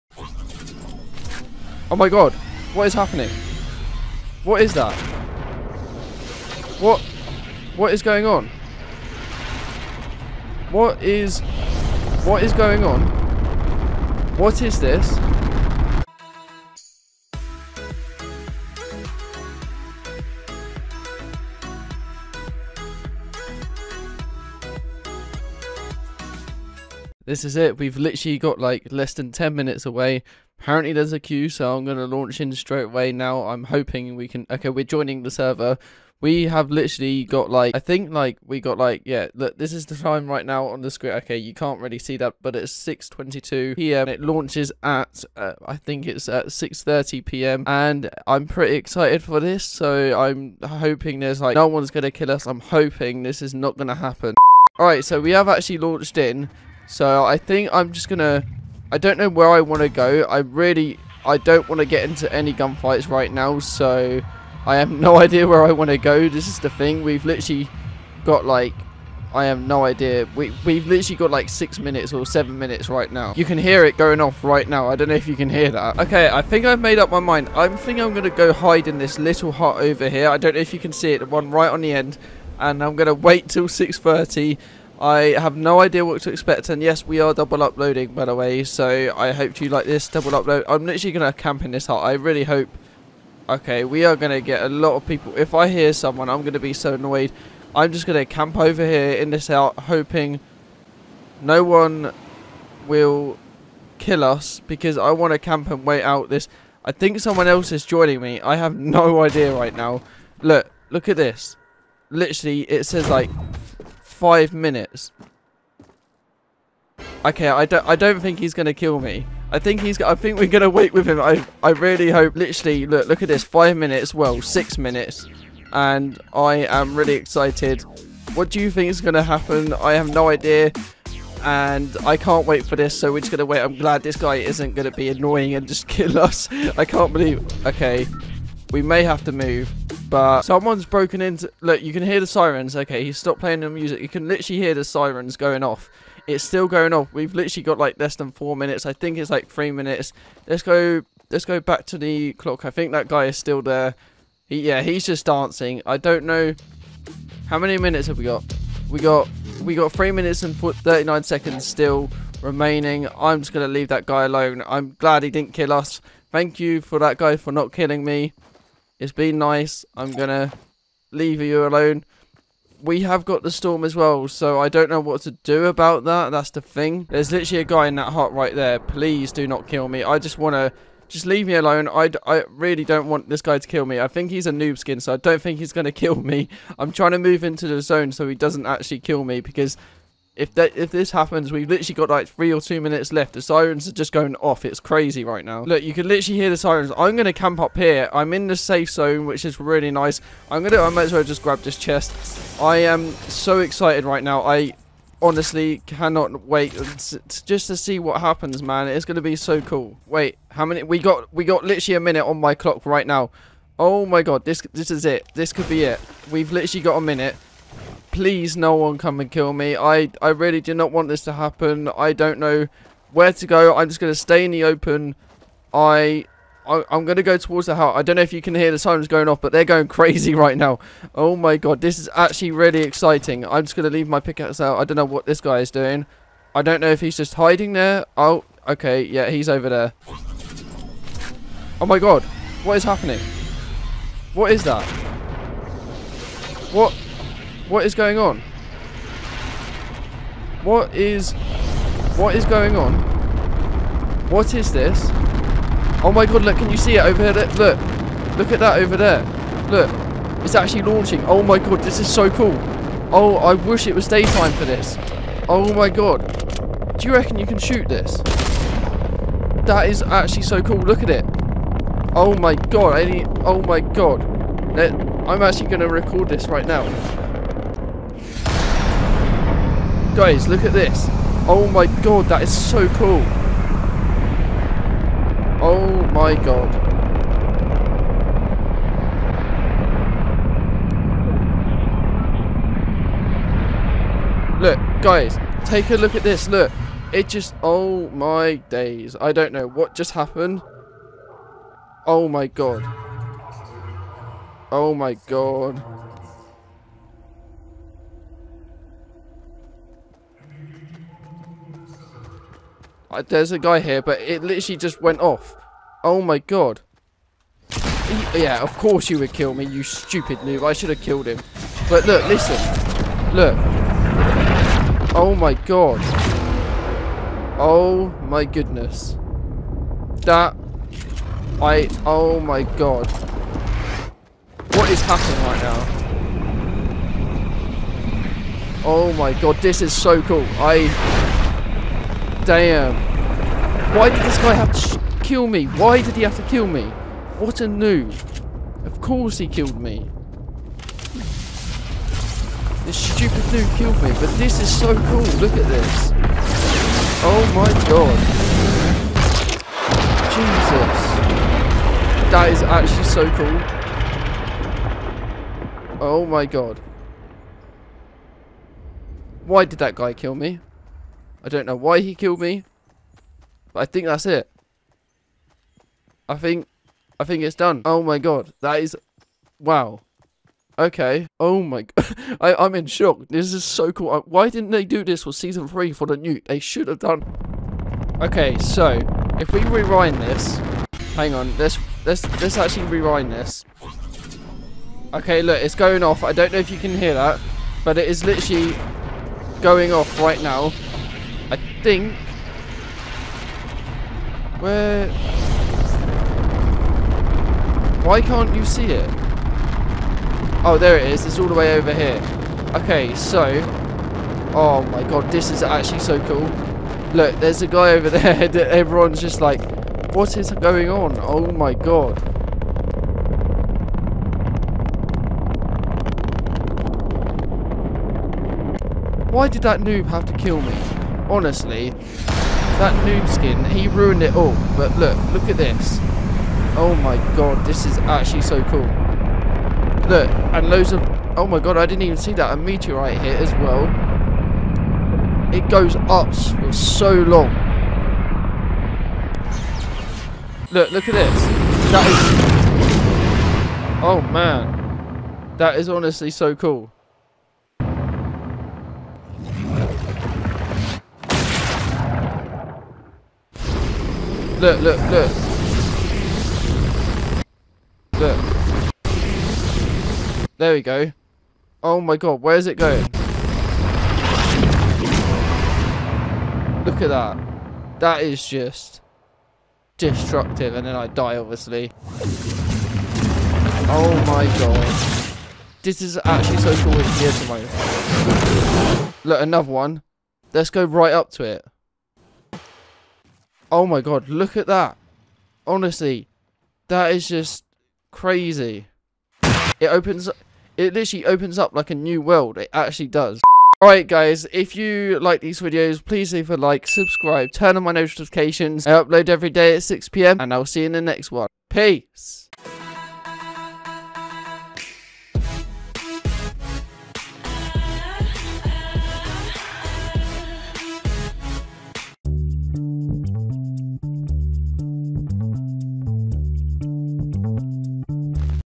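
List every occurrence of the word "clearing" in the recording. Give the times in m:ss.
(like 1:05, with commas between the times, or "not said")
not said.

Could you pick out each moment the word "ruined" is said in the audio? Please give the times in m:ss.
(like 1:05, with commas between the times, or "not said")
7:13.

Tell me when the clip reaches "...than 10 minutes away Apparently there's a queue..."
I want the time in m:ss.
0:29.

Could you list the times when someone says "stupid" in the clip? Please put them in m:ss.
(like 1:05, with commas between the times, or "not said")
5:19, 5:52.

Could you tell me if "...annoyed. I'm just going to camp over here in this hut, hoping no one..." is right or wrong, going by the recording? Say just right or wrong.
right.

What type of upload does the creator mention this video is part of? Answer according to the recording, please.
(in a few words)
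Double upload.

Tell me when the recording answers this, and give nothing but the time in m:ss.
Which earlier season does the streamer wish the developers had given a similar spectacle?
6:25.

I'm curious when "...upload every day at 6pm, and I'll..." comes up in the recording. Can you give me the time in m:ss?
8:28.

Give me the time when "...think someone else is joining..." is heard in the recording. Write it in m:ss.
1:46.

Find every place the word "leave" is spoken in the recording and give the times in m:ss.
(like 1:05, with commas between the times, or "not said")
2:43, 2:51, 3:01, 3:53, 8:26.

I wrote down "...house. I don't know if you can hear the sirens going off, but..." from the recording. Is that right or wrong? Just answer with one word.
right.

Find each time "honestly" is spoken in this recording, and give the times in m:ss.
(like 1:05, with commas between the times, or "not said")
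3:25, 7:11, 7:35, 8:15.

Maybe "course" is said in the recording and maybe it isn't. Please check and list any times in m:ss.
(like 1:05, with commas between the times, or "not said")
5:18, 5:48.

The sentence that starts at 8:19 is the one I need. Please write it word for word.
It opens it literally opens up like a new world.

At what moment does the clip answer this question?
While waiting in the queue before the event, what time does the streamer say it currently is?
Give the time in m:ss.
0:42.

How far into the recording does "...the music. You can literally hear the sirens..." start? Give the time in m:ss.
2:23.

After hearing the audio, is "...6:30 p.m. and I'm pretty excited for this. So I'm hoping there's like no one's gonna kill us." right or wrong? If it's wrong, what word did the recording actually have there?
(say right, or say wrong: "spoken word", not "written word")
right.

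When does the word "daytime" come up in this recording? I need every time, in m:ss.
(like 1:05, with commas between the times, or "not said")
4:24.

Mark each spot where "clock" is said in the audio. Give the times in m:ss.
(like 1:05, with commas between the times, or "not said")
2:32, 3:32.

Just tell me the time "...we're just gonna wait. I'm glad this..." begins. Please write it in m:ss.
2:13.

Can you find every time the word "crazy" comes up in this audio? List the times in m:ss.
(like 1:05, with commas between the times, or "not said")
3:14, 3:49, 8:18.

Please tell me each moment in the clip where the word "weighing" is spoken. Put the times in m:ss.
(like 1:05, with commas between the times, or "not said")
not said.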